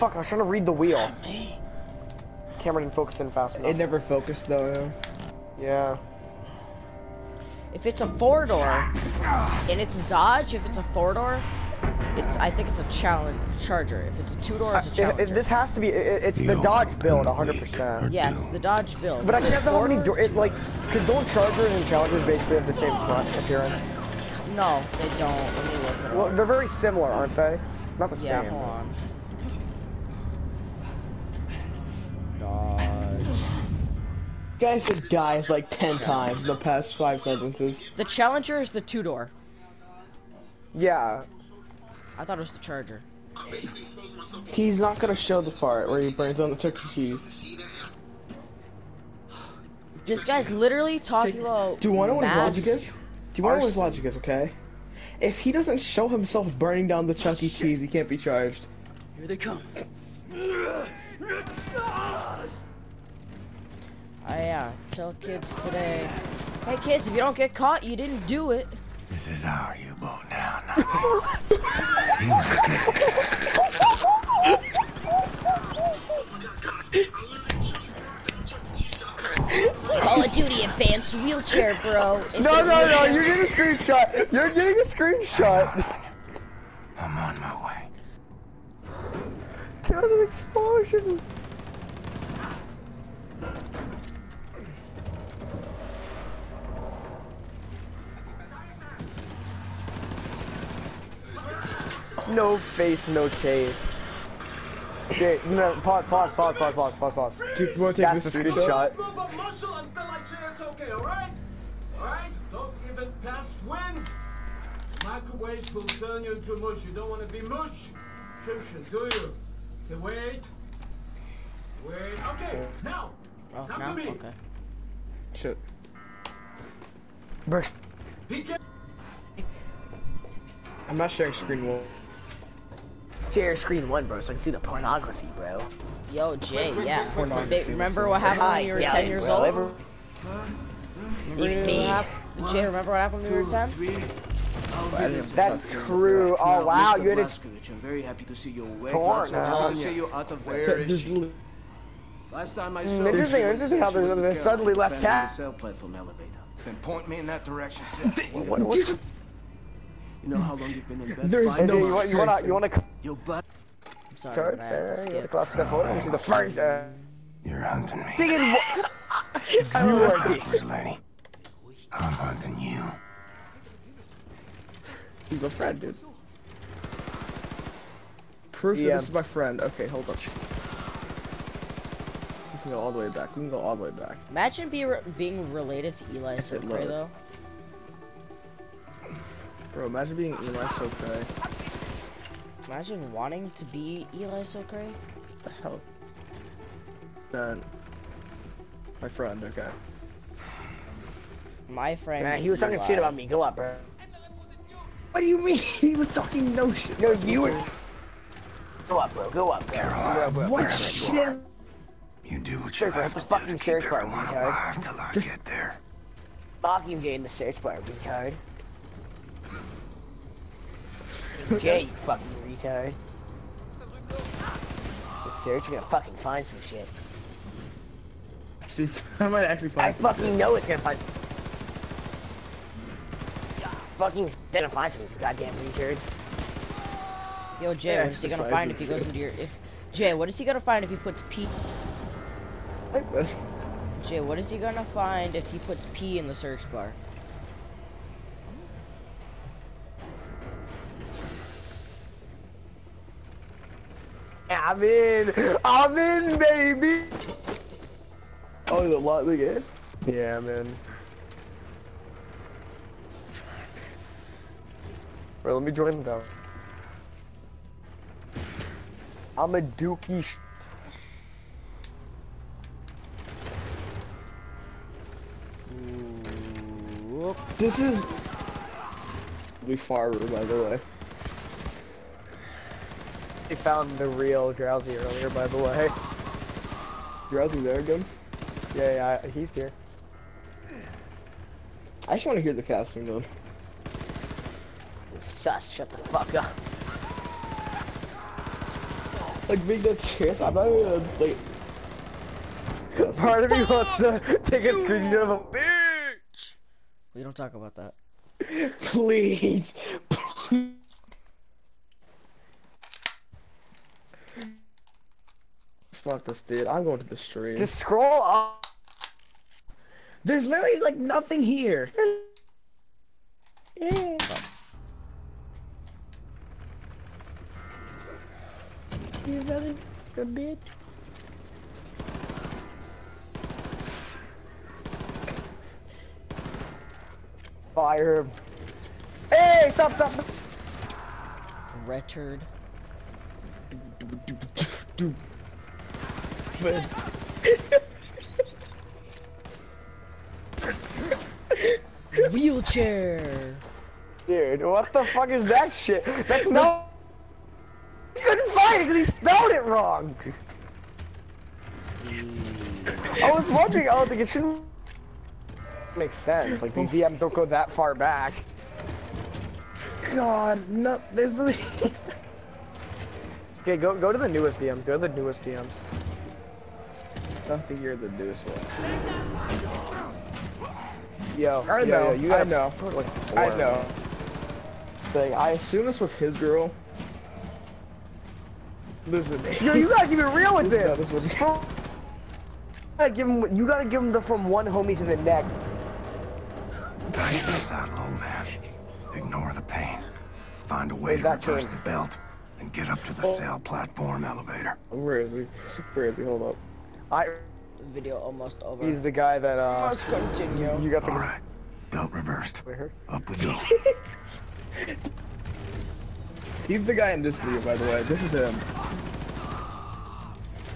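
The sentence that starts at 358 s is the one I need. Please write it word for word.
He couldn't find it because he spelled it wrong!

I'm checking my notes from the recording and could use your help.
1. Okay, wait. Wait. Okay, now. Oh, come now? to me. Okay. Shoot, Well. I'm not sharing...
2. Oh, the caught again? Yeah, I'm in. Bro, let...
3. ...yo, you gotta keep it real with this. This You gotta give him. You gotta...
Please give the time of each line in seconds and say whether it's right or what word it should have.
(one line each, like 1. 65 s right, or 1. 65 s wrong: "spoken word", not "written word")
1. 119 s wrong: "Burst", not "Well"
2. 258 s wrong: "light", not "caught"
3. 389 s right.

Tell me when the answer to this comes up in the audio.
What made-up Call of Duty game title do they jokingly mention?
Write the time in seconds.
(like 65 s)
79 s.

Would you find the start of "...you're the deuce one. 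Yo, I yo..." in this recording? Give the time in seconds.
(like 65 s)
377 s.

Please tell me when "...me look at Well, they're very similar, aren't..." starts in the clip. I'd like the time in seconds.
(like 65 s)
25 s.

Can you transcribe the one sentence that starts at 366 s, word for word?
Like, these VMs don't go that far back.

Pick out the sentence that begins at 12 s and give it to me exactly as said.
I think it's a challenge charger.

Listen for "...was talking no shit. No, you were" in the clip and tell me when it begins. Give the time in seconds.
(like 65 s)
205 s.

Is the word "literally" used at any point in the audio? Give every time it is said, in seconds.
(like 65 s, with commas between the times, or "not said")
50 s, 320 s.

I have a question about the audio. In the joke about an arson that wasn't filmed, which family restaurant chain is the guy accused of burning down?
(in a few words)
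Chuck E. Cheese.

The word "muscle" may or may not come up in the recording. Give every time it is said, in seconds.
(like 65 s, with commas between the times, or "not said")
109 s.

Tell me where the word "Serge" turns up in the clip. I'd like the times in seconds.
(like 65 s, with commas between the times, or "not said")
225 s.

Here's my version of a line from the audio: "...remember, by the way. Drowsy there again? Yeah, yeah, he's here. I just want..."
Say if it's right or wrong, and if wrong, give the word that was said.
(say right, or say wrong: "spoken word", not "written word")
wrong: "earlier", not "remember".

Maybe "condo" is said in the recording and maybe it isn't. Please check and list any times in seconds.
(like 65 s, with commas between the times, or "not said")
not said.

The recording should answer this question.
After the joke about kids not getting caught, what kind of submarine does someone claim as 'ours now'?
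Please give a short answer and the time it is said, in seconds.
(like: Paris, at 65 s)
U-boat, at 69 s.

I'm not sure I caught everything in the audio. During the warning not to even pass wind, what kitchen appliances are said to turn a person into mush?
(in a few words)
Microwaves.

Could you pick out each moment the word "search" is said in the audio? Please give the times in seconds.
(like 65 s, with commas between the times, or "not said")
217 s, 222 s, 246 s.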